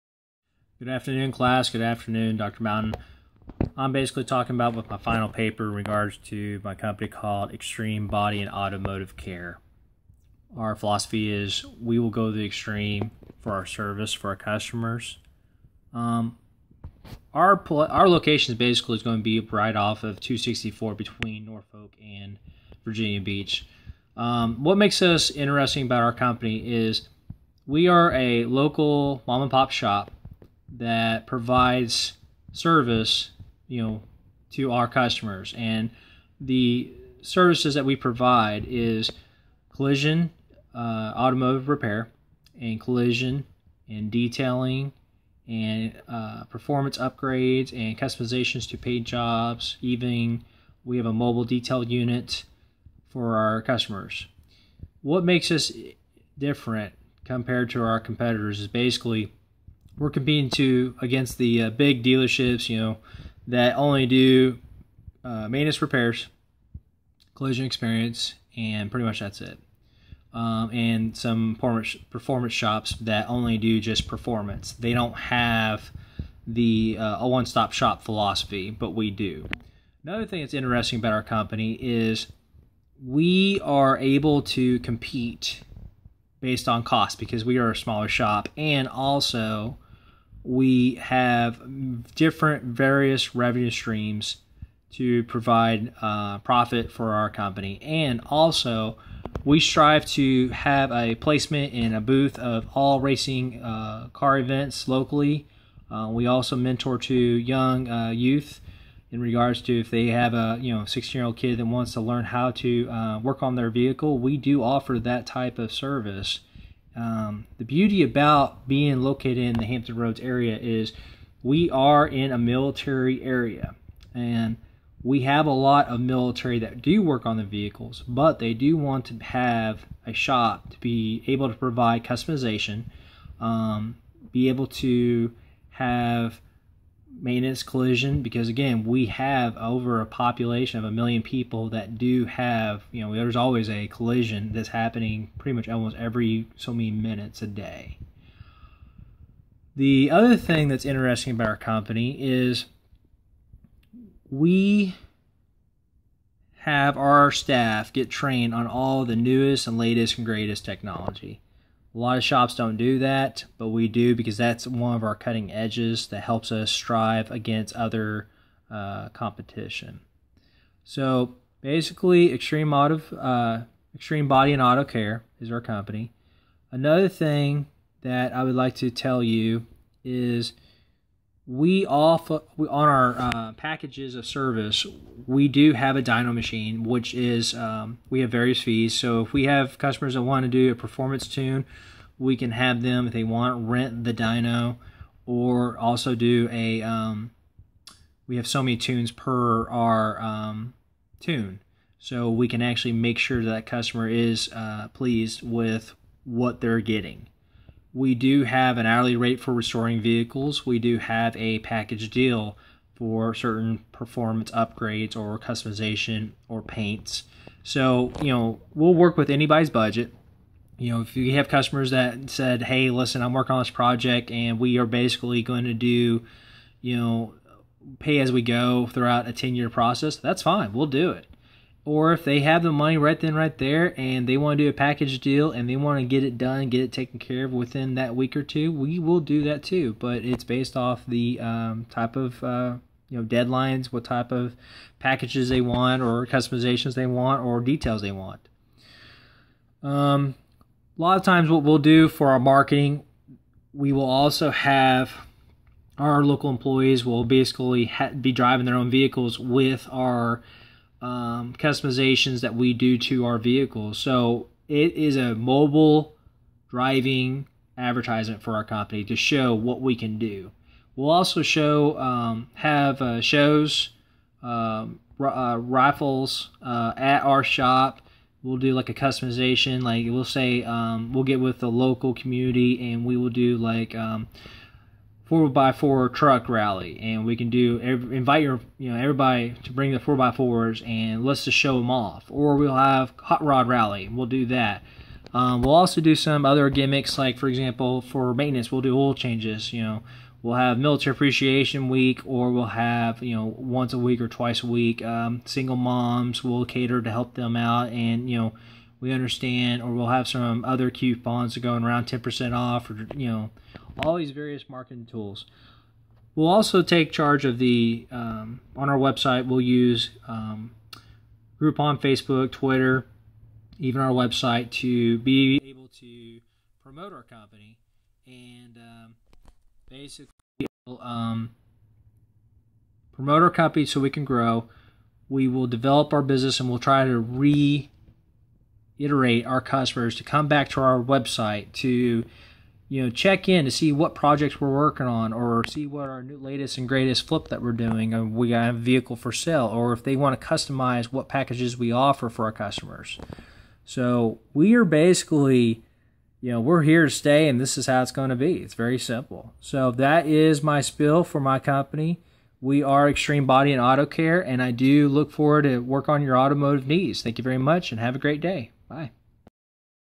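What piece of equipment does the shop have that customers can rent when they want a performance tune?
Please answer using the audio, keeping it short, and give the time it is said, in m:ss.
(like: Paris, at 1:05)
dyno machine, at 3:06.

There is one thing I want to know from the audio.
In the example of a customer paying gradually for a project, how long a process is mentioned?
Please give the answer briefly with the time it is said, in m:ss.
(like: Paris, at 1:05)
10 year, at 3:49.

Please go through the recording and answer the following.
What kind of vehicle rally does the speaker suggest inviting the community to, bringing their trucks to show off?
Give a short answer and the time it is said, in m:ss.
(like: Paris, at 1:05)
four by four truck rally, at 4:45.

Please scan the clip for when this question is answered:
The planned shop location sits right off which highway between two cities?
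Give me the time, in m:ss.
0:20.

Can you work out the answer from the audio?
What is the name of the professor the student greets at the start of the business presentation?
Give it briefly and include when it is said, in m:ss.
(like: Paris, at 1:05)
Dr. Mountain, at 0:02.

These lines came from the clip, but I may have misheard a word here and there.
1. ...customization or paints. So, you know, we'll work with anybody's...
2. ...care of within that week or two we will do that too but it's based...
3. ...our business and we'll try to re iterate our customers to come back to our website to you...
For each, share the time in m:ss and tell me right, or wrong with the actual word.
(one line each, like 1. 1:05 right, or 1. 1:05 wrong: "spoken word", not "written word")
1. 3:35 right
2. 3:57 right
3. 5:36 right.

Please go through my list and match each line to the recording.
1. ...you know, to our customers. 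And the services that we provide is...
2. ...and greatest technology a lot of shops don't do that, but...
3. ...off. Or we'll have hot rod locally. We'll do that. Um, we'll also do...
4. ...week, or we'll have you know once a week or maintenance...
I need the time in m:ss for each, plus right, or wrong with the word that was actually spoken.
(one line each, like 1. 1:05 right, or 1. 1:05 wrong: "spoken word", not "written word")
1. 0:33 right
2. 2:40 right
3. 4:51 wrong: "rally", not "locally"
4. 5:01 wrong: "twice", not "maintenance".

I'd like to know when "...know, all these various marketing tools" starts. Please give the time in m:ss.
5:13.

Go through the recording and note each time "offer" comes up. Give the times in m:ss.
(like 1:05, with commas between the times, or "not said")
1:54, 5:51.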